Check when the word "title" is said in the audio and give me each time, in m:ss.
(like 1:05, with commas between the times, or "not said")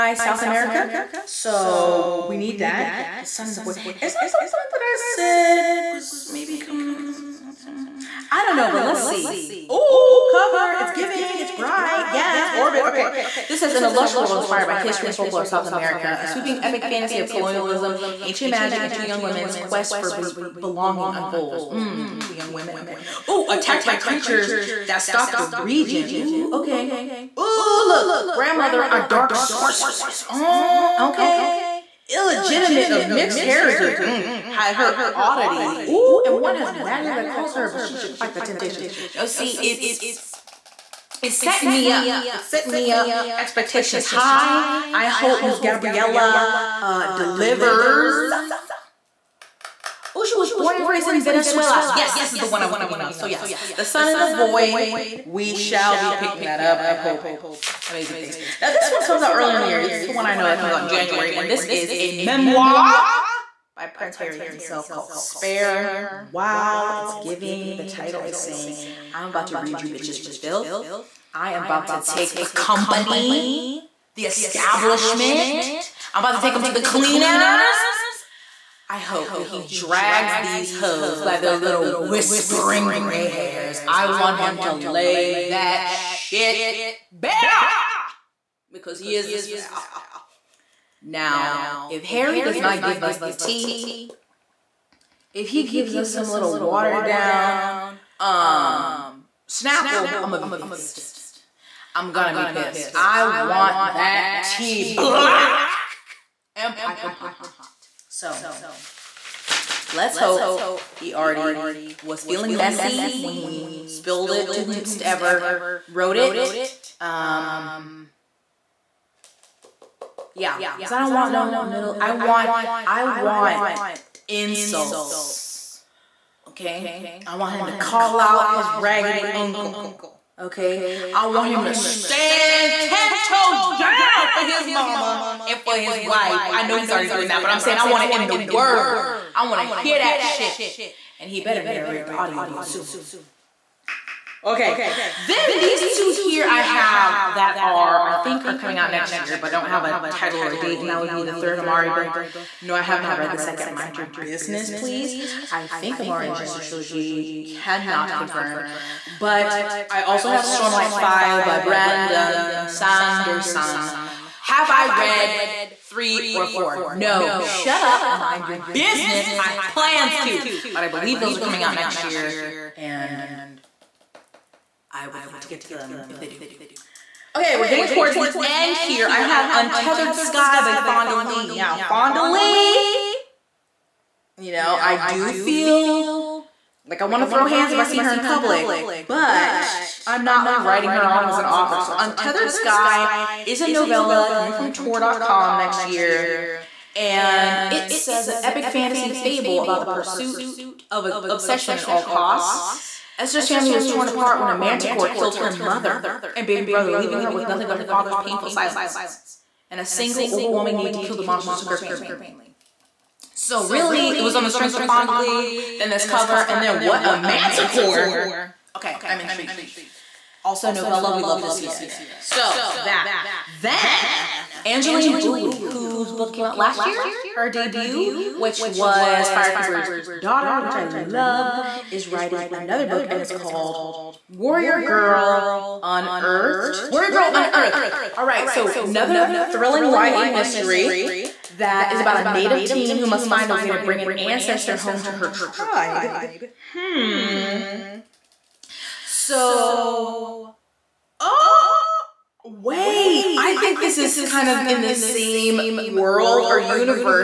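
1:07, 2:30.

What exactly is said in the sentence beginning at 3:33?
So really, it was on the strength of Fonda Lee, then this cover, and then what a manticore.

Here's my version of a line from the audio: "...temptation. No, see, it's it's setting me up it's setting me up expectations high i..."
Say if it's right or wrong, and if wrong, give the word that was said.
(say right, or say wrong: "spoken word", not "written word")
right.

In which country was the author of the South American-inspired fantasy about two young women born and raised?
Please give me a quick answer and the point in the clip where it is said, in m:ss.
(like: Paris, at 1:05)
Venezuela, at 0:51.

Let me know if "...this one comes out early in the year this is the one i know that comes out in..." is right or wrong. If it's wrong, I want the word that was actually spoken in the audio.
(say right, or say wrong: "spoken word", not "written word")
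right.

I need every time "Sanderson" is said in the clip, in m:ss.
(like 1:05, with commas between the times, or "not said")
2:42.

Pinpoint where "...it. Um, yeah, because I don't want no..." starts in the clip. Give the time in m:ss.
1:56.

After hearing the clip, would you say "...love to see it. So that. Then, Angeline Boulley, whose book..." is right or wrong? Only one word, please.
right.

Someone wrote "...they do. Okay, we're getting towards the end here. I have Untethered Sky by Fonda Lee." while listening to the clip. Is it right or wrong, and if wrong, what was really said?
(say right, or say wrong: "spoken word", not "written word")
right.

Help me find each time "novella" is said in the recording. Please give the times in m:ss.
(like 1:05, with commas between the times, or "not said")
3:13, 3:40.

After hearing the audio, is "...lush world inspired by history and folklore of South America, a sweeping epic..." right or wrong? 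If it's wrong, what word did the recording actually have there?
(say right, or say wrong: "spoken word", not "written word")
right.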